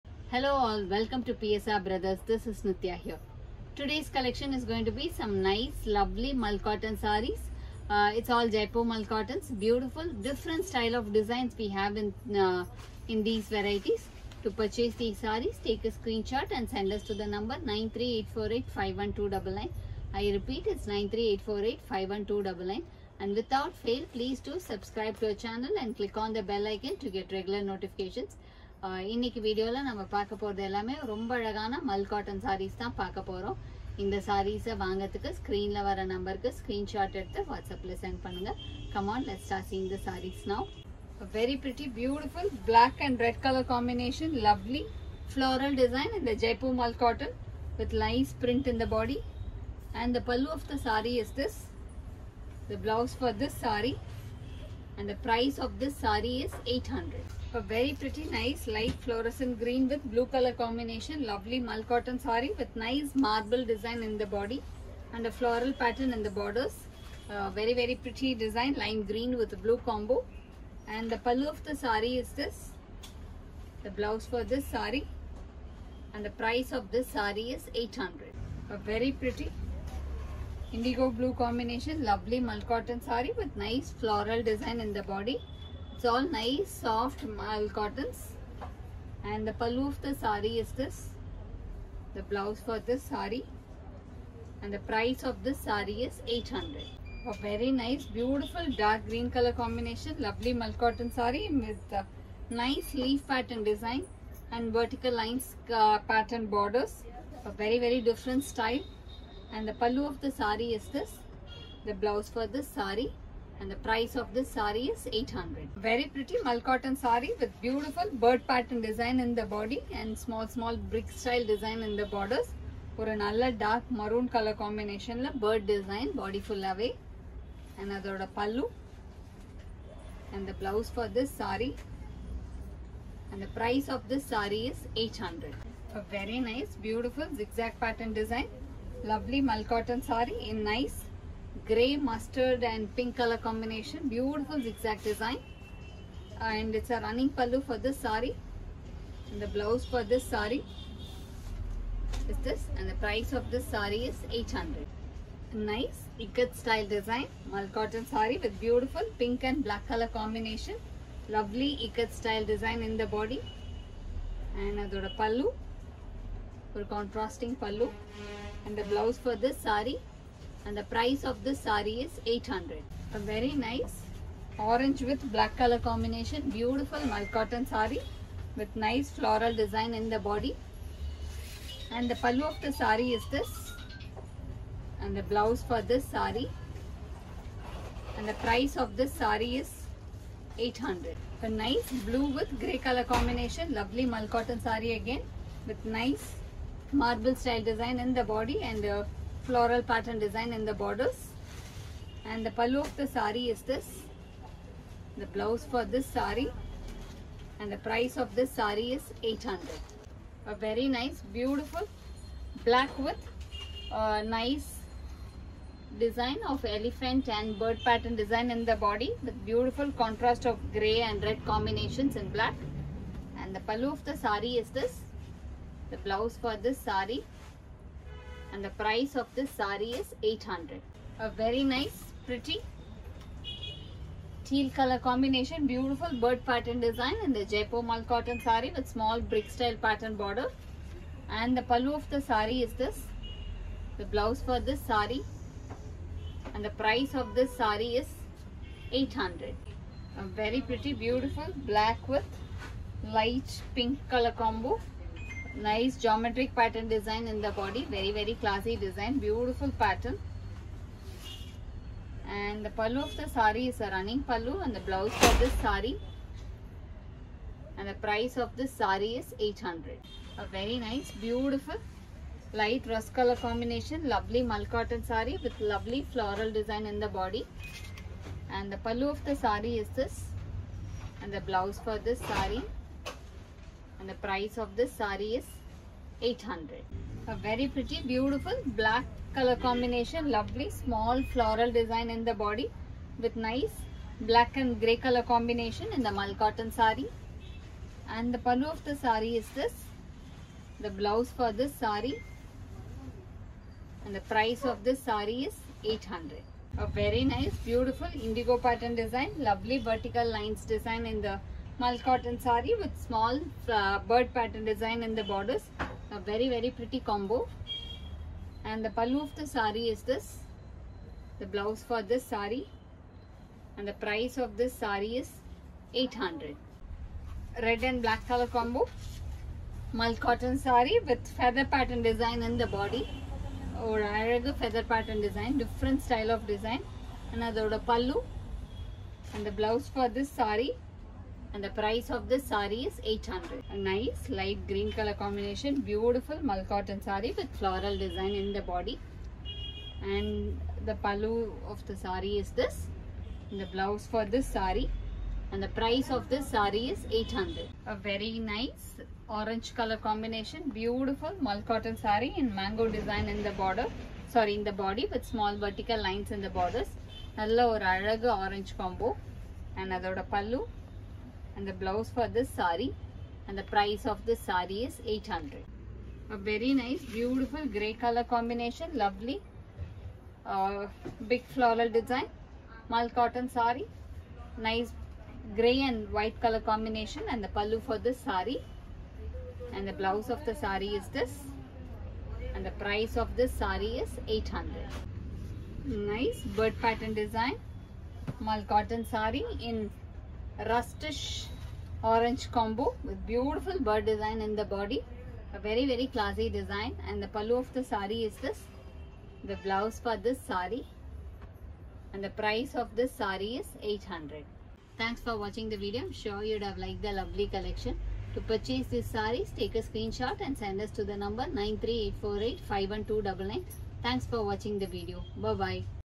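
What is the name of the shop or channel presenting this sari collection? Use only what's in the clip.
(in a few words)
PSR Brothers.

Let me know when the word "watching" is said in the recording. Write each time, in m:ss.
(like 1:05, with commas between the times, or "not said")
6:55, 7:04.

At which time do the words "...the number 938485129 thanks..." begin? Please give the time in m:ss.
7:01.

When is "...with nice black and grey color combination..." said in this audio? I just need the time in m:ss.
4:53.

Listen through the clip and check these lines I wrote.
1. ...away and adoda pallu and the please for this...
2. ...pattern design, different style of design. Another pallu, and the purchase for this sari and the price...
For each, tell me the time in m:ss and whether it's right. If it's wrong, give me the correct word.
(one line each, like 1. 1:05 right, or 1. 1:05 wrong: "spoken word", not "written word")
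1. 2:06 wrong: "blouse", not "please"
2. 5:34 wrong: "blouse", not "purchase".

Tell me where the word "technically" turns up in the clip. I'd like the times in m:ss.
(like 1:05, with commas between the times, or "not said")
not said.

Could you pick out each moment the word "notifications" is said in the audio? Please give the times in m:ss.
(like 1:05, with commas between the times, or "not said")
0:27.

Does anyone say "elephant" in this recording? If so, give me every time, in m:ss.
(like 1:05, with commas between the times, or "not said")
3:36.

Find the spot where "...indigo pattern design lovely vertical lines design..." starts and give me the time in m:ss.
5:08.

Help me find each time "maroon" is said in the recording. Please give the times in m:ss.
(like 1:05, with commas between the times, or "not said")
2:03.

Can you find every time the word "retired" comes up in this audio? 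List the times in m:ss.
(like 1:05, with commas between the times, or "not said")
not said.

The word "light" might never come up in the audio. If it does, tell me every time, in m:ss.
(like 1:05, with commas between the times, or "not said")
0:58, 4:13, 4:32, 5:44.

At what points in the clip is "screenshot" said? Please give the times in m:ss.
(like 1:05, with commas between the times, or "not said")
0:15, 6:59.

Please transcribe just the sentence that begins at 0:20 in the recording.
I repeat, it's nine three eight four eight five one two double nine.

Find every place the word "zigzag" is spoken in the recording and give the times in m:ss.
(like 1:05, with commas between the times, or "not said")
2:17, 2:24.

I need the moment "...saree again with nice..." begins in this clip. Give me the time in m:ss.
3:14.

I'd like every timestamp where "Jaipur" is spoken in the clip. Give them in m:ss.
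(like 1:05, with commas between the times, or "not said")
0:08, 0:46, 3:57.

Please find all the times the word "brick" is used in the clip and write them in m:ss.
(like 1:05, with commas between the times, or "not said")
2:00, 3:59.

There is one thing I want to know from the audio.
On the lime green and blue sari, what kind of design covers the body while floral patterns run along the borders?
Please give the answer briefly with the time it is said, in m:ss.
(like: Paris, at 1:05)
Marble design, at 1:03.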